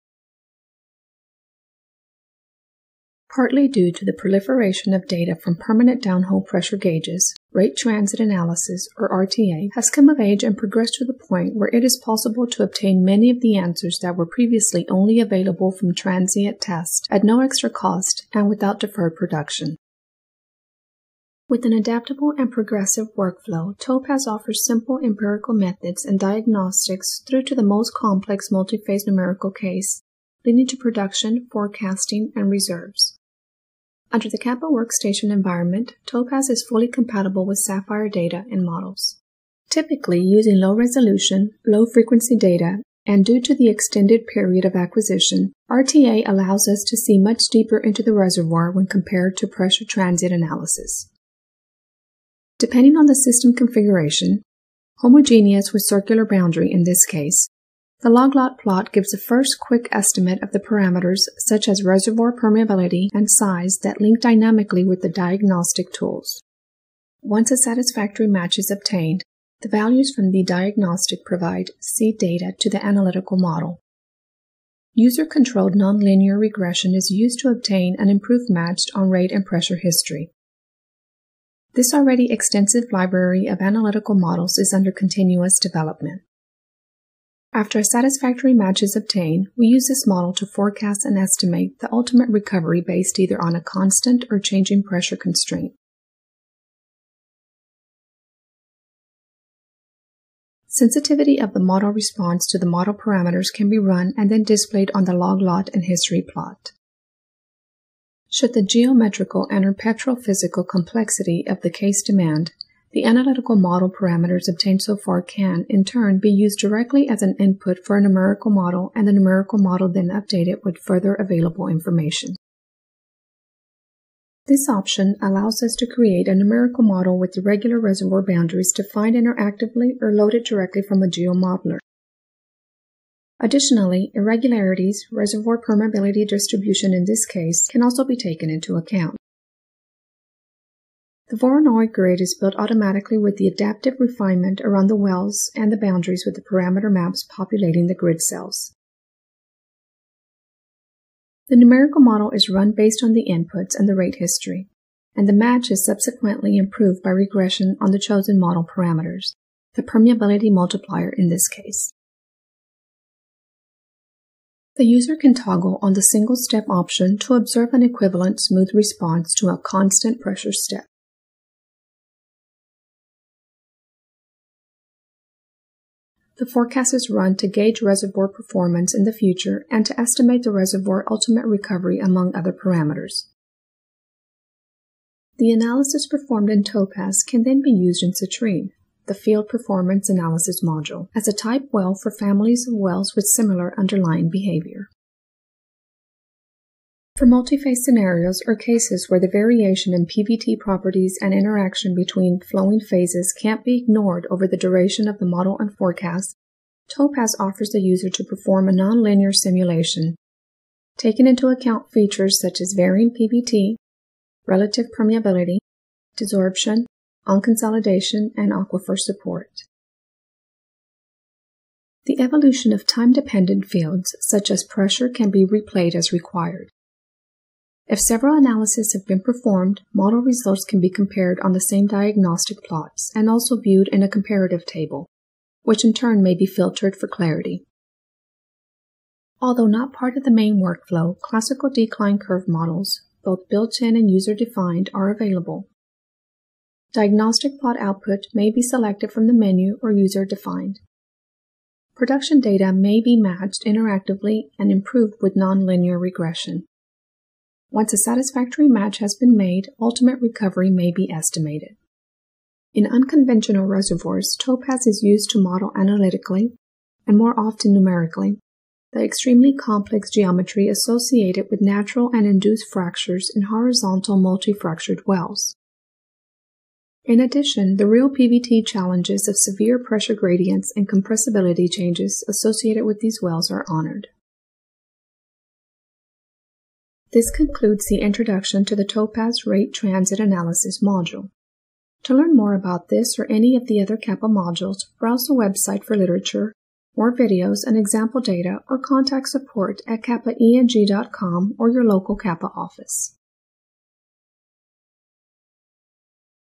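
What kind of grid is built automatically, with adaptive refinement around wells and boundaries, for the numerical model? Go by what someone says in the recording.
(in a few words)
Voronoi grid.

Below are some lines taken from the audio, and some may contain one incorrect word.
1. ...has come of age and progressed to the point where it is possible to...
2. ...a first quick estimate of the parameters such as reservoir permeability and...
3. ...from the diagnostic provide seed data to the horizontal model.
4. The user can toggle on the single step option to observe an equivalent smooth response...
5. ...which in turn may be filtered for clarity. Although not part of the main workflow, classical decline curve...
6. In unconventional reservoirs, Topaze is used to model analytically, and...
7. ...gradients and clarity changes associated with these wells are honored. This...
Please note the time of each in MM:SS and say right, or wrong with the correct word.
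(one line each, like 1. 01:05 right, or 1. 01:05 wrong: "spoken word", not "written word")
1. 00:09 right
2. 00:59 right
3. 01:10 wrong: "analytical", not "horizontal"
4. 02:44 right
5. 03:55 right
6. 04:22 right
7. 04:40 wrong: "compressibility", not "clarity".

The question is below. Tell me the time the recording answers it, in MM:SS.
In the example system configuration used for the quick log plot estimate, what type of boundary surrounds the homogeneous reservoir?
00:55.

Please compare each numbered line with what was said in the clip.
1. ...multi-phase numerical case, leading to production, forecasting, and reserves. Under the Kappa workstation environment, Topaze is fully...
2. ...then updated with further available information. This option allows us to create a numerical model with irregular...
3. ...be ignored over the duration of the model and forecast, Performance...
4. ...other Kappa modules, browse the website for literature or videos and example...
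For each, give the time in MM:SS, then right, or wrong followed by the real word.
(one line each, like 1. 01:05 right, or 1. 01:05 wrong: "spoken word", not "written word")
1. 00:28 right
2. 01:59 right
3. 03:23 wrong: "Topaze", not "Performance"
4. 04:53 right.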